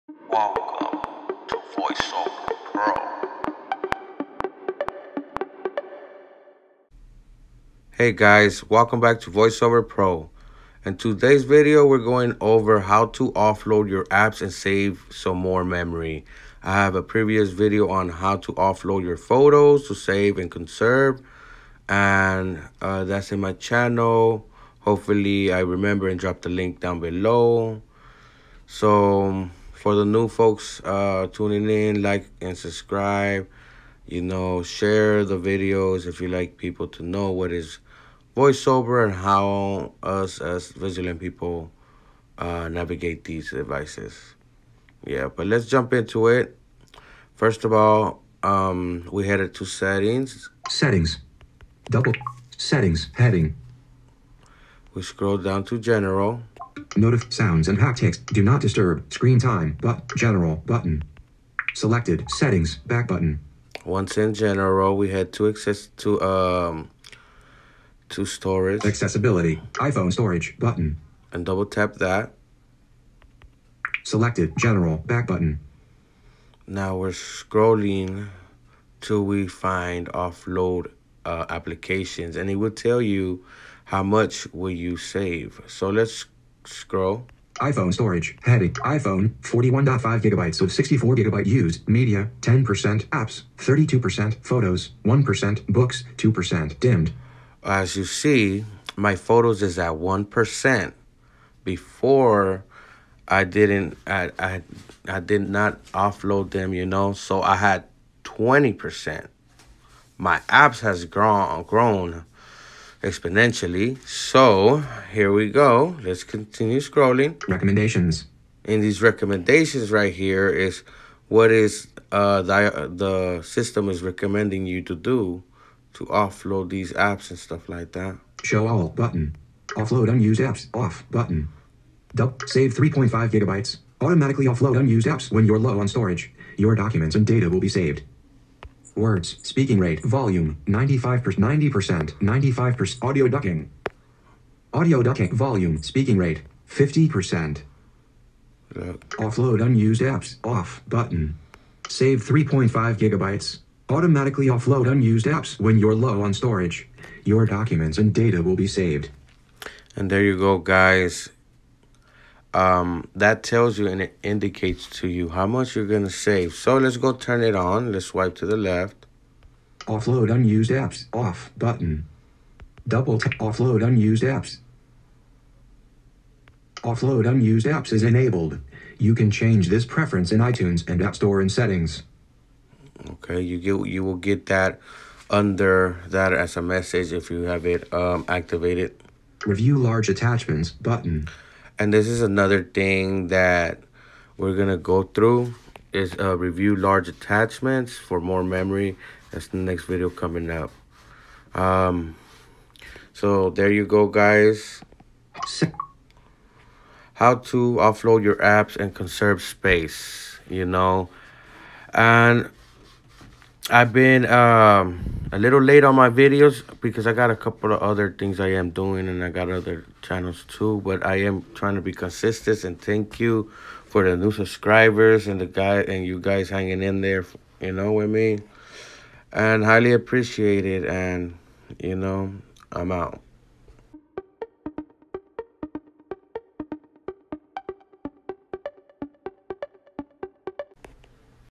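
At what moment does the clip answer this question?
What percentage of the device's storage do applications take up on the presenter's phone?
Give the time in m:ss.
1:33.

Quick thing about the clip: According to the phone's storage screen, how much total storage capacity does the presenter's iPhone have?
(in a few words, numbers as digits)
64 gigabytes.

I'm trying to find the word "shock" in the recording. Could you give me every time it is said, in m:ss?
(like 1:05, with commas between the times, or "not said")
not said.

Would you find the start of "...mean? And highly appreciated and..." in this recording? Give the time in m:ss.
3:48.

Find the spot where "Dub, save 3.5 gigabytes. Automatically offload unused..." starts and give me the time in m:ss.
2:12.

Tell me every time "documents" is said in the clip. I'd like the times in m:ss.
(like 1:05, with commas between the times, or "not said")
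2:16, 2:37.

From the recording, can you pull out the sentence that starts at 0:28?
So for the new folks uh, tuning in, like and subscribe.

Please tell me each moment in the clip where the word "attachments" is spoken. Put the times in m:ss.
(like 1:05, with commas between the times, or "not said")
3:10, 3:17.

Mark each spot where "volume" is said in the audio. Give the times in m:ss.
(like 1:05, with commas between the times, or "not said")
2:20, 2:25.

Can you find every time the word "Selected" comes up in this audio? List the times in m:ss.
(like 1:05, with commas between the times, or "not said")
1:01, 1:14.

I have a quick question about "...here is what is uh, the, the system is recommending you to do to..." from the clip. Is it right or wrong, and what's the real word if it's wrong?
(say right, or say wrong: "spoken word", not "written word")
right.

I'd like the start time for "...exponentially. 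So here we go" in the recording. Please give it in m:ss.
1:53.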